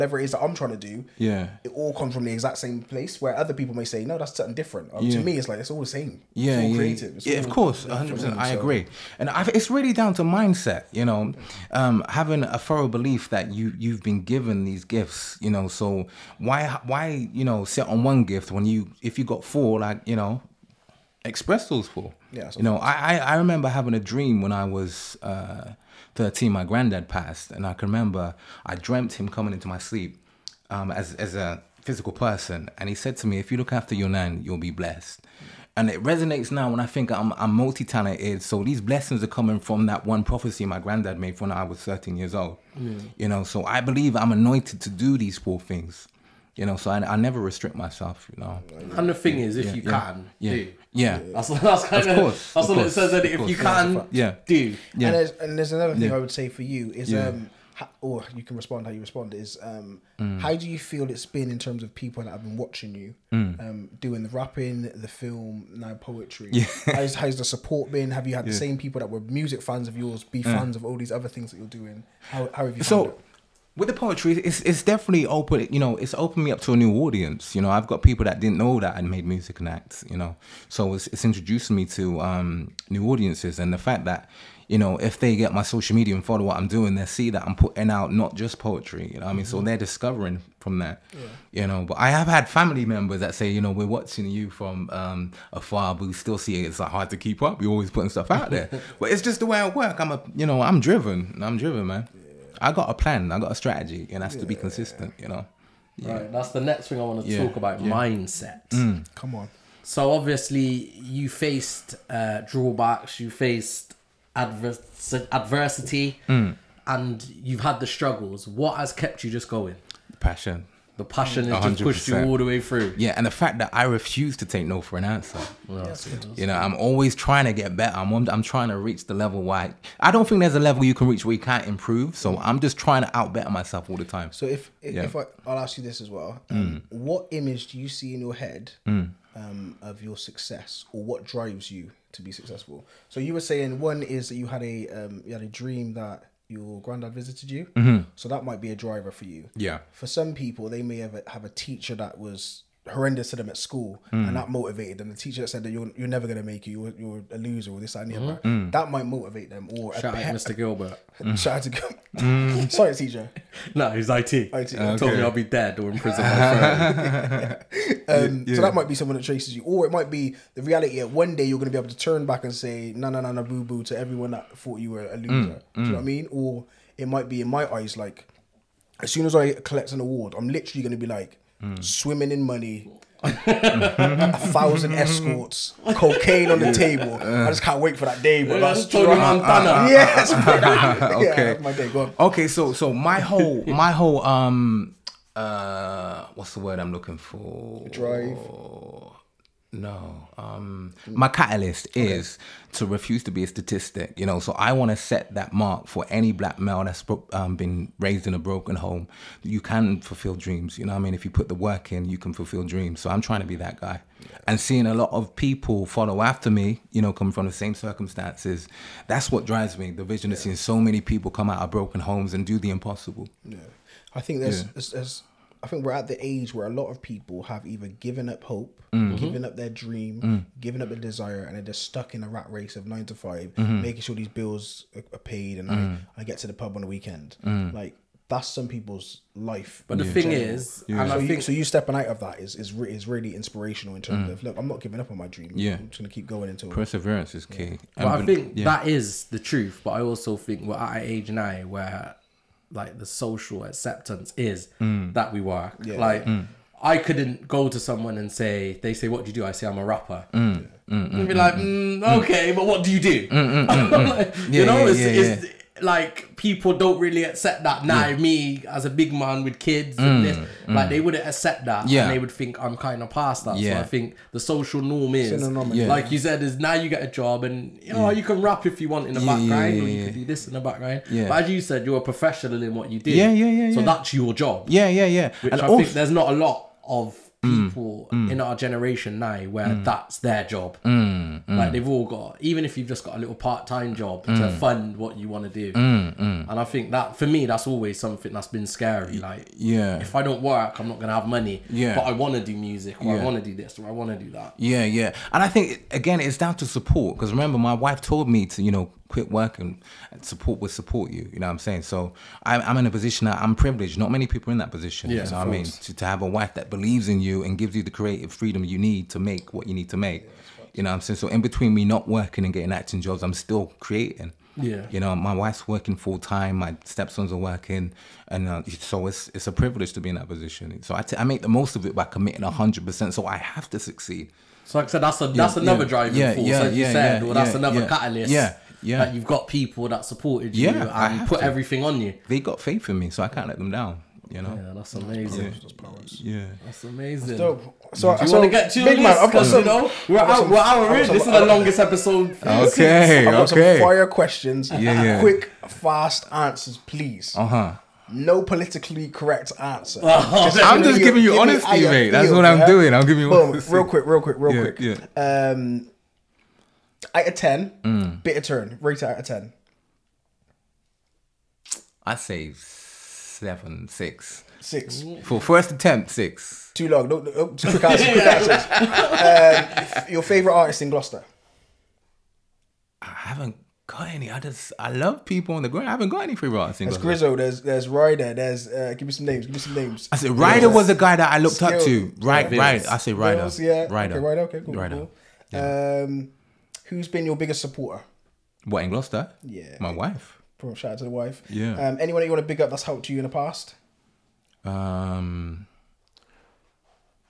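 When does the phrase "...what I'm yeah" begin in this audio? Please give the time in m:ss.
6:02.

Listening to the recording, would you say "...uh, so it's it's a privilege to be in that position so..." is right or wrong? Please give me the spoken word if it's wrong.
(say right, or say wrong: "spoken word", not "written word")
right.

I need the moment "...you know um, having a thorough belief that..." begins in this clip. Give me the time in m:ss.
0:10.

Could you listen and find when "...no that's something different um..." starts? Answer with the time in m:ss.
0:04.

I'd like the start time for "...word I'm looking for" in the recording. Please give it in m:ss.
3:16.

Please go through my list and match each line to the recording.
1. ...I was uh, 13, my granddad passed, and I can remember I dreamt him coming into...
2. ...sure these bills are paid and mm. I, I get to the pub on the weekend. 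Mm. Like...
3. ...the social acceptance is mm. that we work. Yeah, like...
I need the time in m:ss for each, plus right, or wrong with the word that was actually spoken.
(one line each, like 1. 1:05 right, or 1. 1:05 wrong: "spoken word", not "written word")
1. 0:24 right
2. 3:54 right
3. 4:12 right.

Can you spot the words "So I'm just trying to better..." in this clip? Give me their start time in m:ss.
2:12.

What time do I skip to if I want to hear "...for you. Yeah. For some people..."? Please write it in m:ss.
2:29.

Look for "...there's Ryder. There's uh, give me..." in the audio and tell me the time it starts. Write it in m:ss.
6:27.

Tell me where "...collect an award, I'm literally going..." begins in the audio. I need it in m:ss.
2:59.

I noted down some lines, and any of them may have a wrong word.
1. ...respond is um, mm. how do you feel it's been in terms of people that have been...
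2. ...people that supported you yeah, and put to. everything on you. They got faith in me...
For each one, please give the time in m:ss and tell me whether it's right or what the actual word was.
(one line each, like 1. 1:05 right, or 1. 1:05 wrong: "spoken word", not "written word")
1. 0:59 right
2. 5:39 right.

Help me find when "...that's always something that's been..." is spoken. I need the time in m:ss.
4:57.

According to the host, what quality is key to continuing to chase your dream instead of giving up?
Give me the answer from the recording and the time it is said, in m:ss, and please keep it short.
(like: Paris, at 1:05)
perseverance, at 4:06.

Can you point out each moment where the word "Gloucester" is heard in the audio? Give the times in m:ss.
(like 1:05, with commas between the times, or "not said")
6:20, 6:38.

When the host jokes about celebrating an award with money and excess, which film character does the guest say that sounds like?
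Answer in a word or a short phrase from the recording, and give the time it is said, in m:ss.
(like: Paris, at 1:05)
Tony Montana, at 3:08.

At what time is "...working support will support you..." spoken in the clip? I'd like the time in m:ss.
5:09.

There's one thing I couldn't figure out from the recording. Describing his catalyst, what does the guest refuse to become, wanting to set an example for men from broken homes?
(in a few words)
a statistic.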